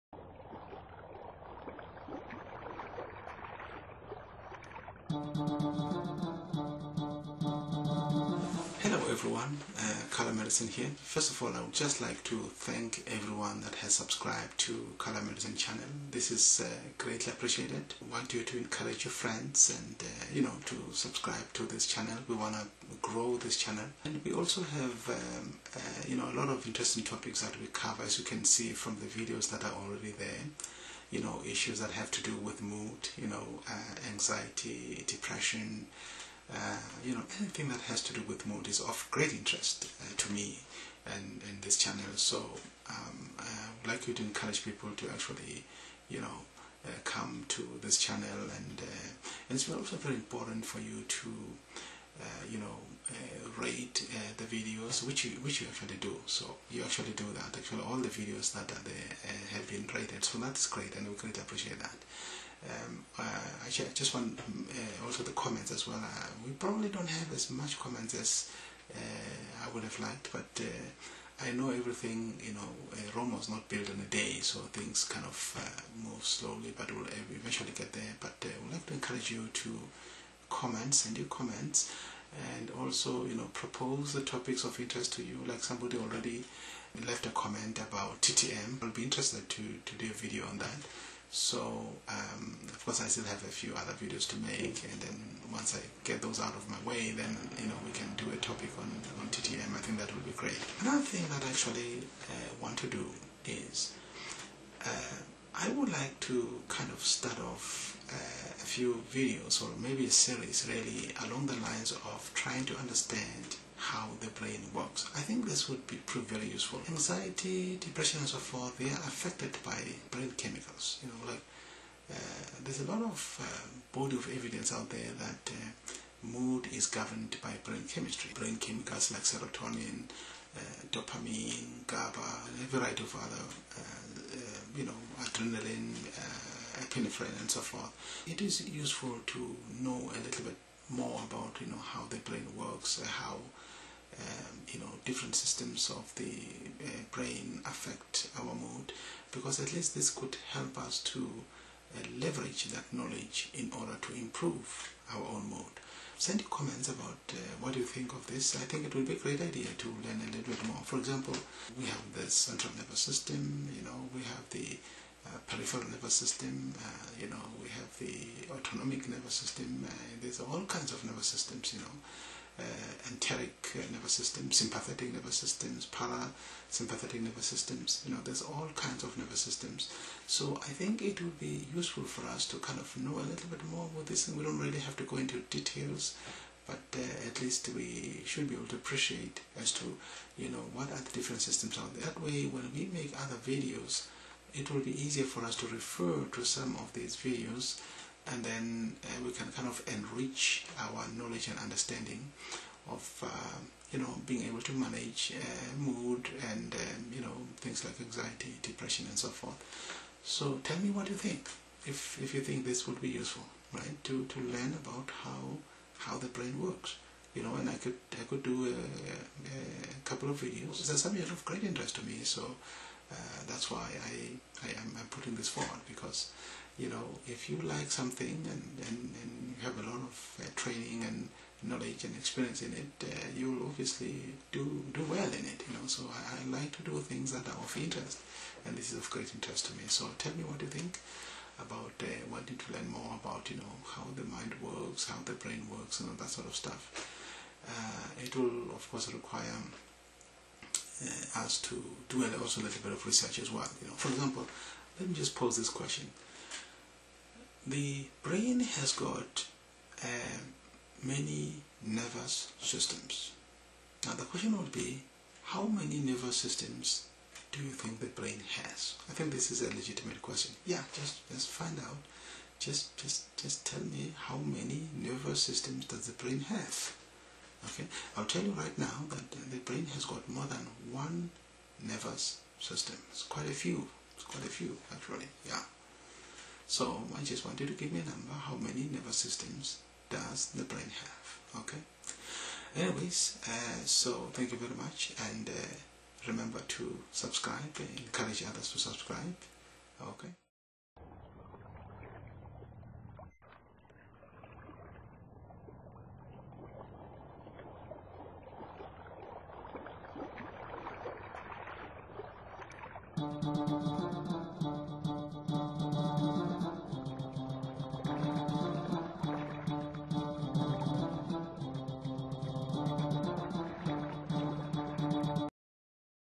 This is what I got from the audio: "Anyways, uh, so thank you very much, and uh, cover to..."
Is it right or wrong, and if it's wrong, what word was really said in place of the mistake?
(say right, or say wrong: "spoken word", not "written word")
wrong: "remember", not "cover".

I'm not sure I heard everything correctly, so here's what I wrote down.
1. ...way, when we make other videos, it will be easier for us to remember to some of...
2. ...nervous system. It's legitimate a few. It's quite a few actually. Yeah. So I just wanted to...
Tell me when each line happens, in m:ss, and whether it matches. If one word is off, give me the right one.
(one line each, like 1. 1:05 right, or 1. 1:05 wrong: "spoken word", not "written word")
1. 3:12 wrong: "refer", not "remember"
2. 4:41 wrong: "quite", not "legitimate".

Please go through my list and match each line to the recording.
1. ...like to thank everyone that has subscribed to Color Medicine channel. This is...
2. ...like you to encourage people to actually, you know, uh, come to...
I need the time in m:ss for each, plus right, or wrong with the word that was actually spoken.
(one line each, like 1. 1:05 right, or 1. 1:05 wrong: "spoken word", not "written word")
1. 0:11 right
2. 0:43 right.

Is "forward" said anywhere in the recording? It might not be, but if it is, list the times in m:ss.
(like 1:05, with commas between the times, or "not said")
3:45.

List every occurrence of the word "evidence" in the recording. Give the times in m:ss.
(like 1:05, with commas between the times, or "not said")
2:04.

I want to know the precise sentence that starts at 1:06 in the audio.
we probably don't have as much comments as I would have liked, but.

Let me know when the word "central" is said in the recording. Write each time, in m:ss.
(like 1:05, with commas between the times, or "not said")
2:42.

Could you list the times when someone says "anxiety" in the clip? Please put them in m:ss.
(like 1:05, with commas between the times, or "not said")
0:34, 1:56, 3:27.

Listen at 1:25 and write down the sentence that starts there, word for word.
Like somebody already left a comment about TTM.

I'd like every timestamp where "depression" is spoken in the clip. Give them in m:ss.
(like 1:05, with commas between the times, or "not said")
0:35, 1:57, 3:28.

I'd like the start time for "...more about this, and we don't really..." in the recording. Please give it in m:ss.
3:03.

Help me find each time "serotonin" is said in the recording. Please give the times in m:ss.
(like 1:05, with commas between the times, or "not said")
2:09.